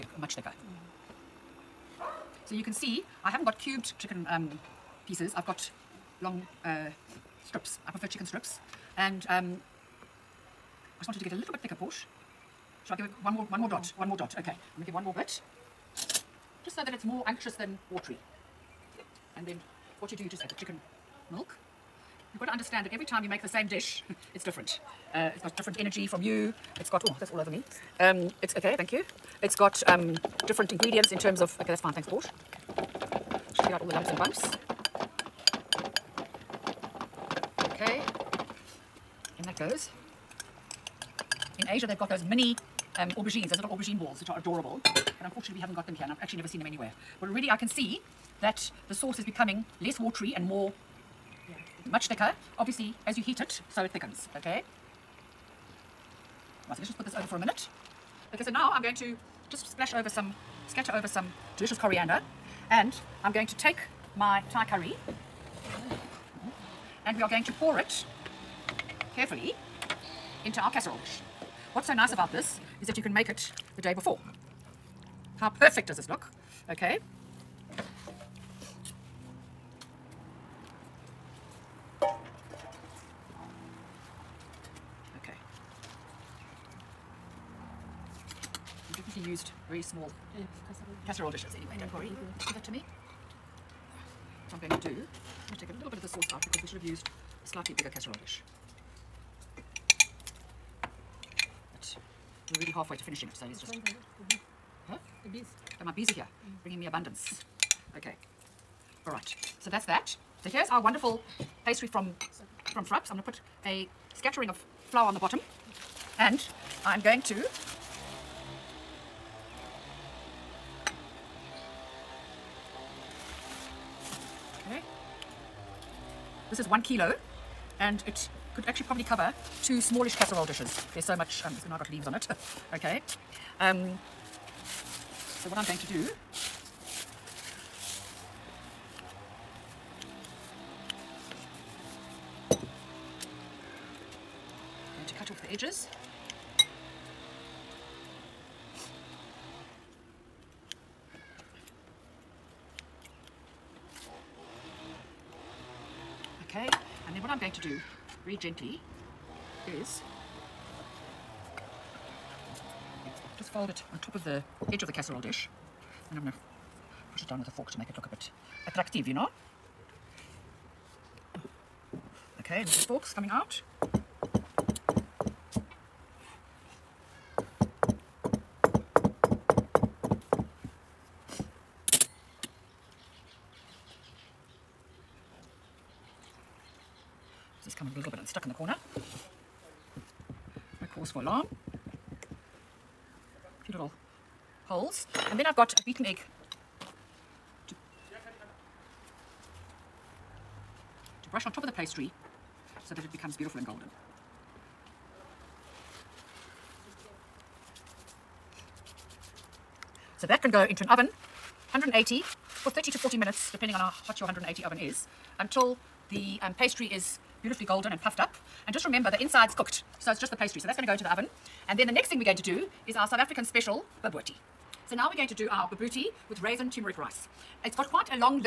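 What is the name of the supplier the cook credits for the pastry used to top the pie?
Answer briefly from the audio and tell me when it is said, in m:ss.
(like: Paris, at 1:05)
Thrupps, at 1:52.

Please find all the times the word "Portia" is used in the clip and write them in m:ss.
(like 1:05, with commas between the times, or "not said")
0:11, 0:32.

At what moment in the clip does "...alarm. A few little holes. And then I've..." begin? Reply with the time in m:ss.
3:11.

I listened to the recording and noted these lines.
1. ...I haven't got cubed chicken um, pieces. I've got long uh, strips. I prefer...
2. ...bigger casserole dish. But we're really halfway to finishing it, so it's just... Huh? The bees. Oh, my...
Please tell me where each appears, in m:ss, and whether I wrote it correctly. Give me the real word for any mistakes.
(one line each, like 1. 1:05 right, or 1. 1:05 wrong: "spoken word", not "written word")
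1. 0:03 right
2. 1:37 right.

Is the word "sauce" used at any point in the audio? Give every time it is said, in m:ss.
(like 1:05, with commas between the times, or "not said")
0:48, 1:36.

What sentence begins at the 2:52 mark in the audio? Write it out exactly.
Okay, and this is forks coming out.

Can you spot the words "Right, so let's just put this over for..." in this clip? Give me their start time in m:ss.
0:56.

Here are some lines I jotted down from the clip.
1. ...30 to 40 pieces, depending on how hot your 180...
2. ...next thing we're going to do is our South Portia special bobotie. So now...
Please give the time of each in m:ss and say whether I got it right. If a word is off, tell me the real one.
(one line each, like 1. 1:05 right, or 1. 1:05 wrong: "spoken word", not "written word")
1. 3:32 wrong: "minutes", not "pieces"
2. 3:41 wrong: "African", not "Portia".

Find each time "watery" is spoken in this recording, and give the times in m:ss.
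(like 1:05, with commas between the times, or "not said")
0:17, 0:49.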